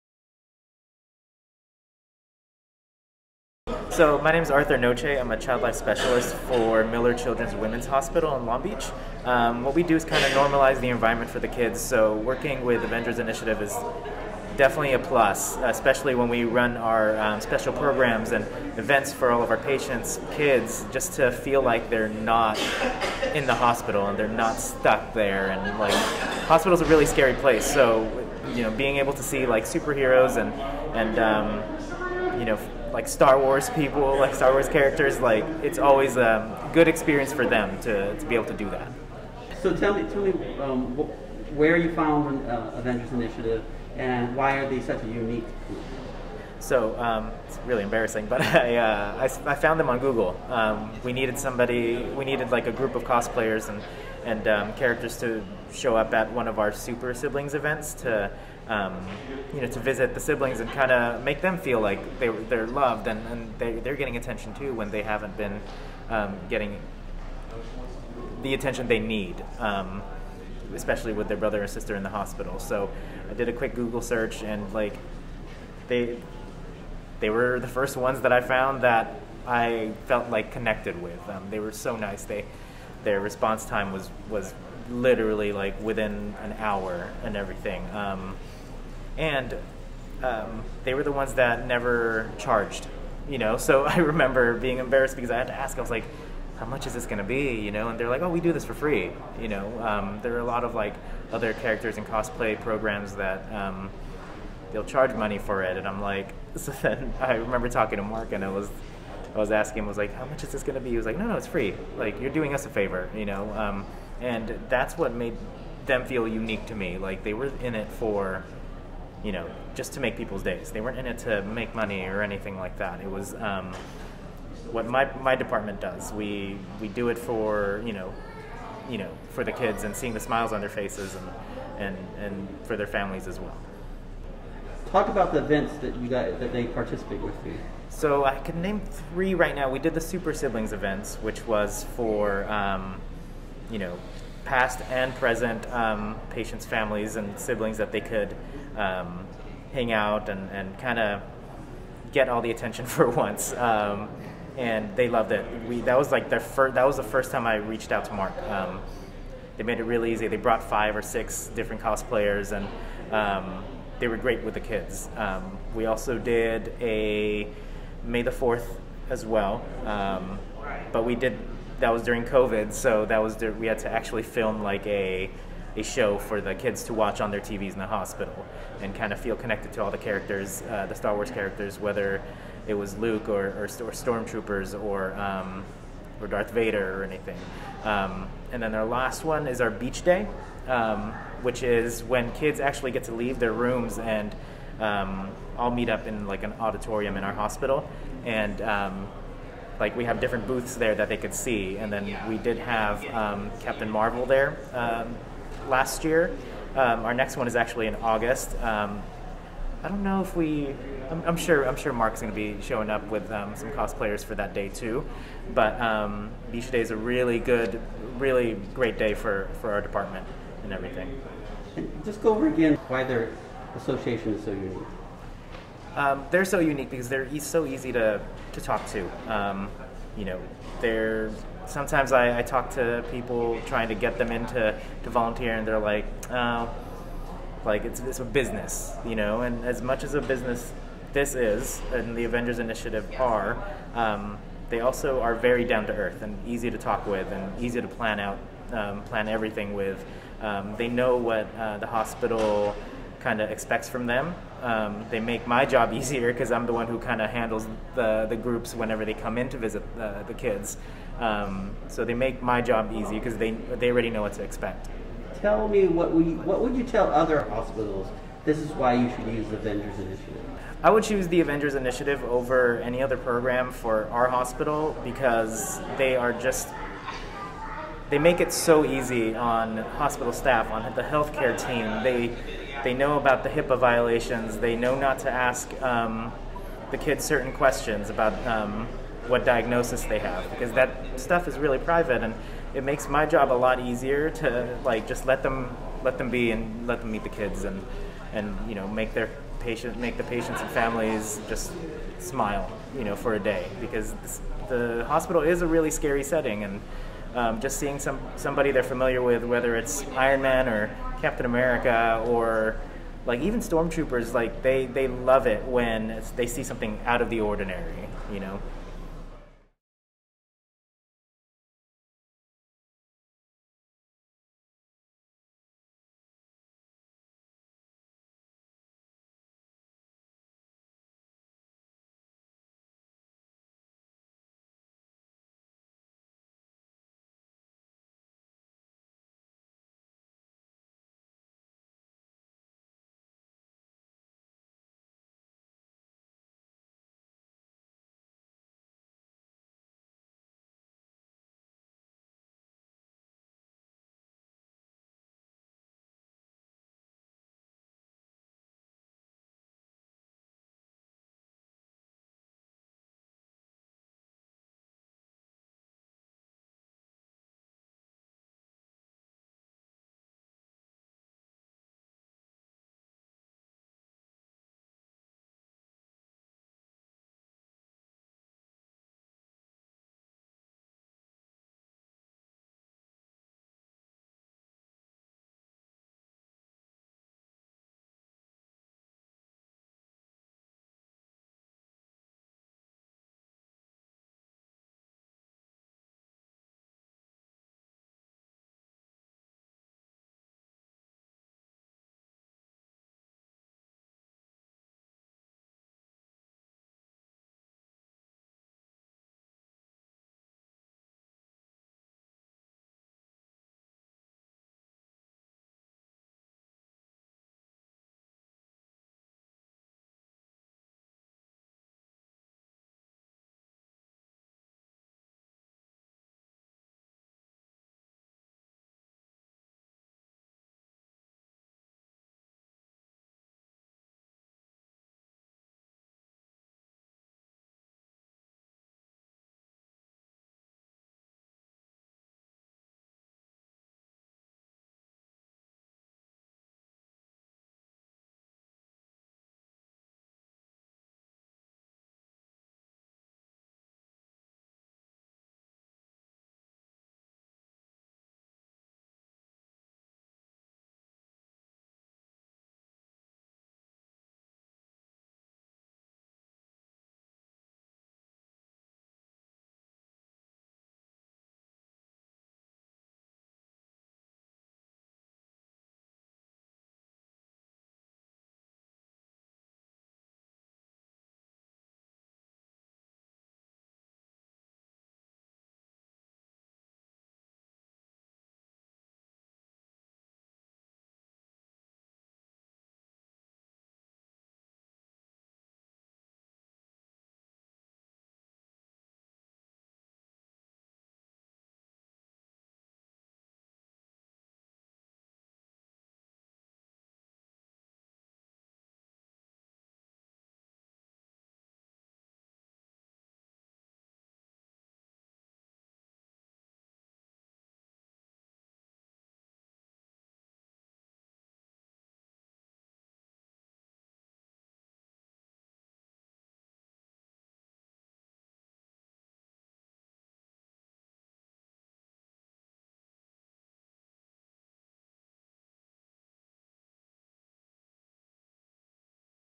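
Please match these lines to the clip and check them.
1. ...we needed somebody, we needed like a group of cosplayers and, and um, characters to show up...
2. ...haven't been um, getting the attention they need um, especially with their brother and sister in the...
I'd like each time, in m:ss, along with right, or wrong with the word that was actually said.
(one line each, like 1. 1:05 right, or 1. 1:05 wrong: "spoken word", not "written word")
1. 0:51 right
2. 1:05 right.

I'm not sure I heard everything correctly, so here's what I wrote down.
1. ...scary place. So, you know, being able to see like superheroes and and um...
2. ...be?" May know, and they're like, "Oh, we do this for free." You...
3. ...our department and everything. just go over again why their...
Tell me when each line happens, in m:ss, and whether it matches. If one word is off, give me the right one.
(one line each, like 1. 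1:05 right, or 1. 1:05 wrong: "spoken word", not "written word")
1. 0:27 right
2. 1:37 wrong: "You", not "May"
3. 3:39 right.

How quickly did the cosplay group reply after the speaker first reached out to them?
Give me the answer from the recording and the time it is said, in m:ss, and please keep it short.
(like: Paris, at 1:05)
within an hour, at 1:25.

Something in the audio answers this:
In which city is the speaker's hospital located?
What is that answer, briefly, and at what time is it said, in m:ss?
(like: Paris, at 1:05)
Long Beach, at 0:08.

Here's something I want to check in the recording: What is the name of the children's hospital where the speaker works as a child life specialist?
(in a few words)
Miller Children's Women's Hospital.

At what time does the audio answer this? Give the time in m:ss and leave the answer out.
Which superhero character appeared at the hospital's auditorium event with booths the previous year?
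3:23.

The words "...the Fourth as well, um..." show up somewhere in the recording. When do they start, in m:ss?
2:48.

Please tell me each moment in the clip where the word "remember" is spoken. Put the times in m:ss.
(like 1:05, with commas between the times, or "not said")
1:33, 1:47.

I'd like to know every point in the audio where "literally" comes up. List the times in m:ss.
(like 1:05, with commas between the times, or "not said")
1:24.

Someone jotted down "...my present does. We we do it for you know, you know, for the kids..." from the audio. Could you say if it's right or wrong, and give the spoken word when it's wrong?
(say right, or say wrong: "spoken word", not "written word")
wrong: "department", not "present".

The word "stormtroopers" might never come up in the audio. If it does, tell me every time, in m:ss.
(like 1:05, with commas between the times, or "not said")
3:03, 5:13.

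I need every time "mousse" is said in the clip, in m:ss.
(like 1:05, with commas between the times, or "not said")
not said.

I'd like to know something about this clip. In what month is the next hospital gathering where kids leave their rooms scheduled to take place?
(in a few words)
August.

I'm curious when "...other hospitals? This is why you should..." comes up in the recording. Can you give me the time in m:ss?
4:27.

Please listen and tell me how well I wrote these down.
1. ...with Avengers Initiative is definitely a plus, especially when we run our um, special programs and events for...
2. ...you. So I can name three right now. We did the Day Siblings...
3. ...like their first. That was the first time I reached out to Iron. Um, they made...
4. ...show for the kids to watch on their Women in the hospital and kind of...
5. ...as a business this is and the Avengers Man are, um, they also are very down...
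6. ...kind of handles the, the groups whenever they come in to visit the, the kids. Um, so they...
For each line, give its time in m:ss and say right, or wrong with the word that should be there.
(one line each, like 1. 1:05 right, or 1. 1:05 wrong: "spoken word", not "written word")
1. 0:12 right
2. 2:17 wrong: "Super", not "Day"
3. 2:36 wrong: "Mark", not "Iron"
4. 2:55 wrong: "TVs", not "Women"
5. 4:00 wrong: "Initiative", not "Man"
6. 4:16 right.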